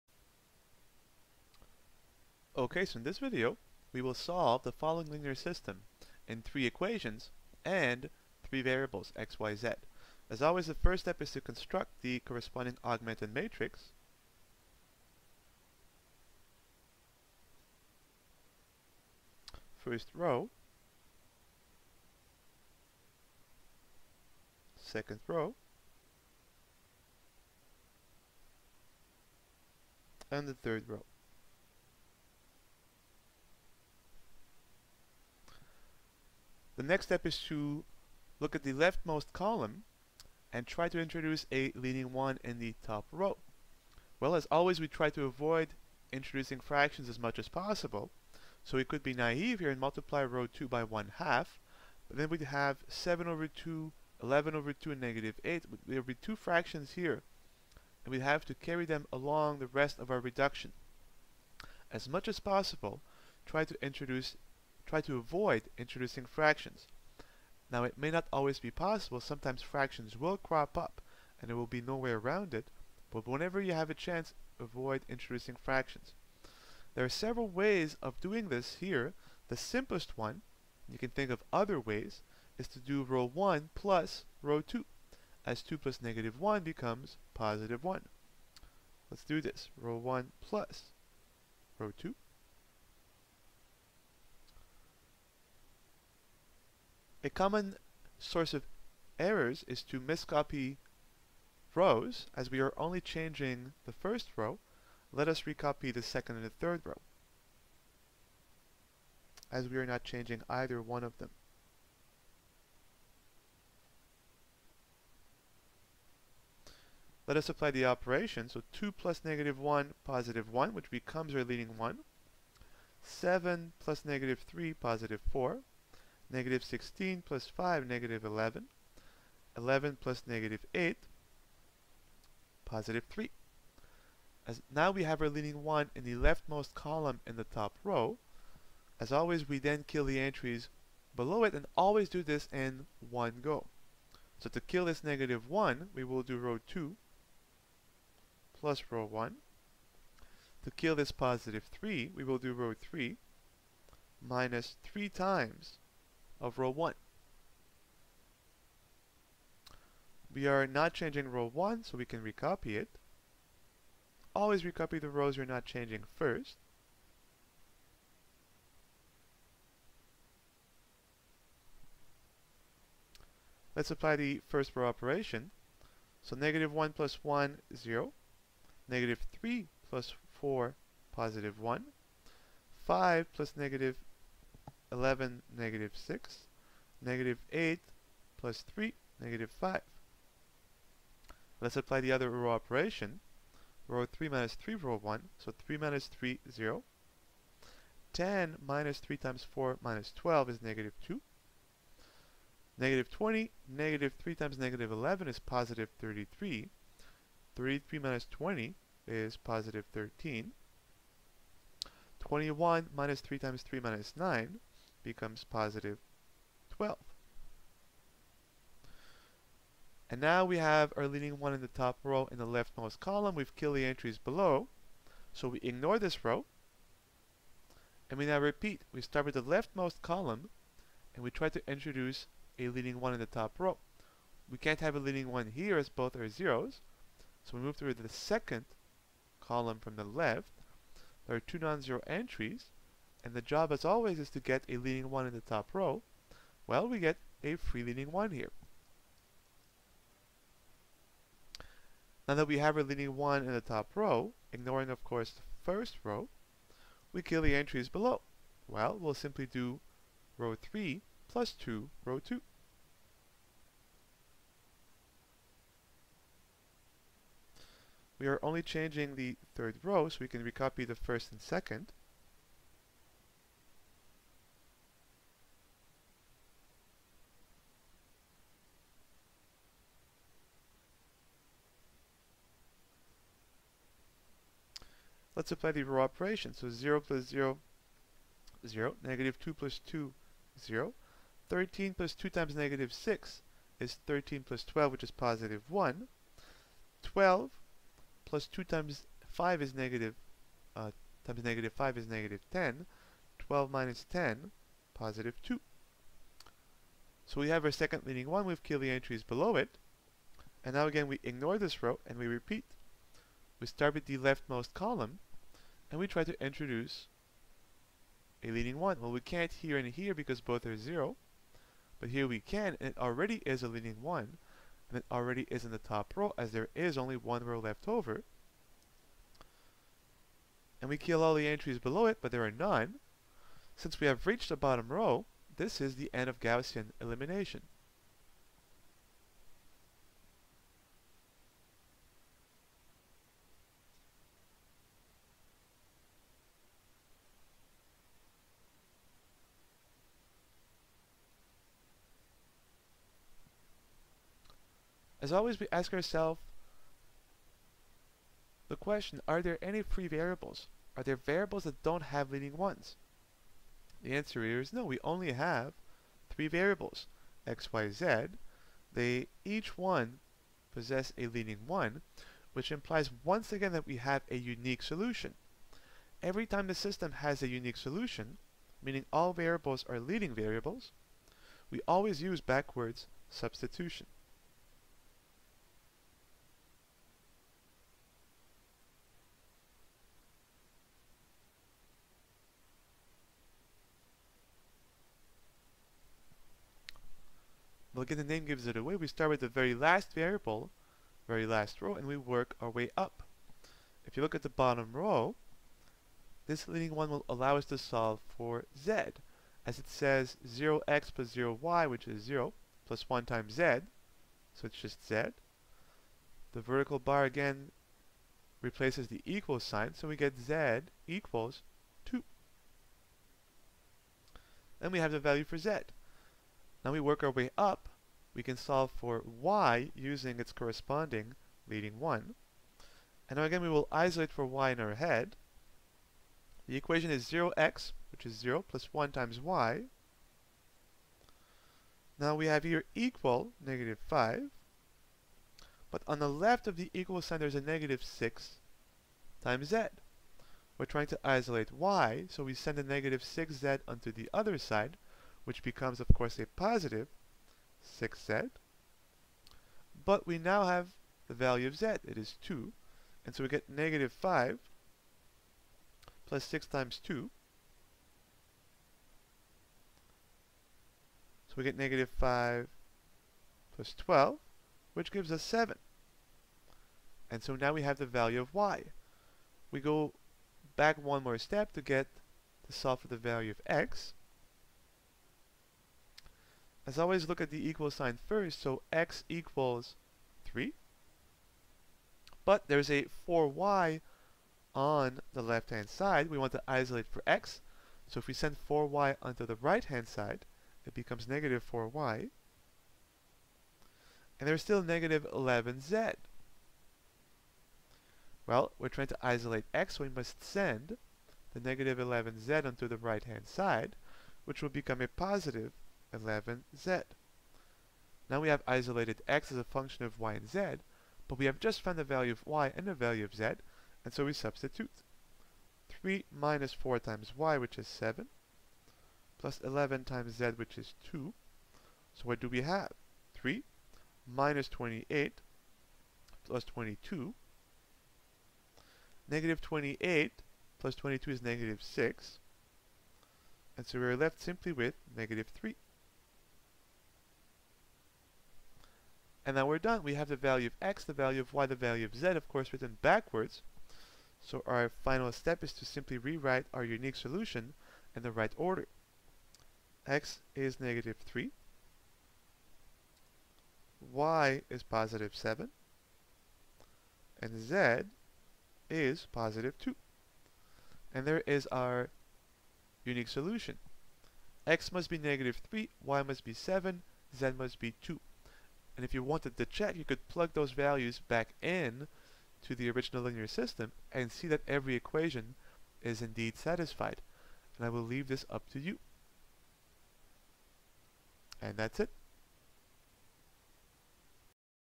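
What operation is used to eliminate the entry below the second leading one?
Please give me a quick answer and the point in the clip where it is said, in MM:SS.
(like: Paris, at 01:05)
Row 3 plus 2 row 2, at 04:20.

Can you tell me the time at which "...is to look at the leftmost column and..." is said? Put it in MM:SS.
00:37.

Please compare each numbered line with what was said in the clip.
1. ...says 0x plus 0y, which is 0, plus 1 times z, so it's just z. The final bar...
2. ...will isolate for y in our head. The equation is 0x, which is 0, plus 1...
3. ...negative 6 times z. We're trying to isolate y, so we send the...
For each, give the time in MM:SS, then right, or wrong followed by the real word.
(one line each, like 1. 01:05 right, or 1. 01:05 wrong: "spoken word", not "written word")
1. 06:49 wrong: "vertical", not "final"
2. 07:13 right
3. 07:27 right.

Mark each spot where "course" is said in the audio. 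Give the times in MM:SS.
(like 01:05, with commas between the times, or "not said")
04:15, 07:36, 09:12.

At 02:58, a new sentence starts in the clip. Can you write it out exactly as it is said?
Negative 3 plus 4, positive 1.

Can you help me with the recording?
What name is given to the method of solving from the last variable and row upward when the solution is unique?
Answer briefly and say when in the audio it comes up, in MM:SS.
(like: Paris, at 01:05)
Backwards substitution, at 06:22.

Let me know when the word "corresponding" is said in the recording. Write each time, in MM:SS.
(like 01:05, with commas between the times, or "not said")
00:12, 07:10.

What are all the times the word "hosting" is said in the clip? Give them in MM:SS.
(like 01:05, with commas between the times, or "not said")
not said.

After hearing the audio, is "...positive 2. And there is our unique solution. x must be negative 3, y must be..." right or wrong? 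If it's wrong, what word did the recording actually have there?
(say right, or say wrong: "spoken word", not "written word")
right.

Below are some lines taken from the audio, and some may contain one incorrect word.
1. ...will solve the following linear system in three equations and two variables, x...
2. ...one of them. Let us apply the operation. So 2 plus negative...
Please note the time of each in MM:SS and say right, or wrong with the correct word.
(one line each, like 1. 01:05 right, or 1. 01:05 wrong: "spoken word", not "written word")
1. 00:04 wrong: "three", not "two"
2. 01:50 right.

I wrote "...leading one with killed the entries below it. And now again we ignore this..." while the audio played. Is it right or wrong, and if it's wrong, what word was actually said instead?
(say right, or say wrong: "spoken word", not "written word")
right.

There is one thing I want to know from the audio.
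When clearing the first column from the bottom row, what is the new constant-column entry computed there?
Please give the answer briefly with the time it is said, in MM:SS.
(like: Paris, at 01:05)
12, at 03:35.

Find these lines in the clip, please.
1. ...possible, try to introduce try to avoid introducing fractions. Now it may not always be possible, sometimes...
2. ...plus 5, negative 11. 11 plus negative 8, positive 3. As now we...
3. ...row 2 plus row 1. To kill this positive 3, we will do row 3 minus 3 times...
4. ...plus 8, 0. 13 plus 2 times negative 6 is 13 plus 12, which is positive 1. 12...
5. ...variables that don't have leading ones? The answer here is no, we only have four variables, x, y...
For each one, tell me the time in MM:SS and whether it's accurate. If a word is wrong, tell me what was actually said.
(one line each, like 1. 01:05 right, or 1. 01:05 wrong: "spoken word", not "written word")
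1. 01:02 right
2. 02:07 right
3. 02:26 right
4. 04:49 wrong: "2", not "8"
5. 06:01 wrong: "three", not "four".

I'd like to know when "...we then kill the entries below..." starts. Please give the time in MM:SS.
02:19.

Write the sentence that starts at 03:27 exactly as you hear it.
33 minus 20 is positive 13.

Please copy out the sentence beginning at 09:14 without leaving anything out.
So our final step is to simply rewrite our unique solution in the right order.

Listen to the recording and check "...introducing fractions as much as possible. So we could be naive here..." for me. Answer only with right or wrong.
right.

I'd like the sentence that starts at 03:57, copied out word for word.
So we move through the second column from the left.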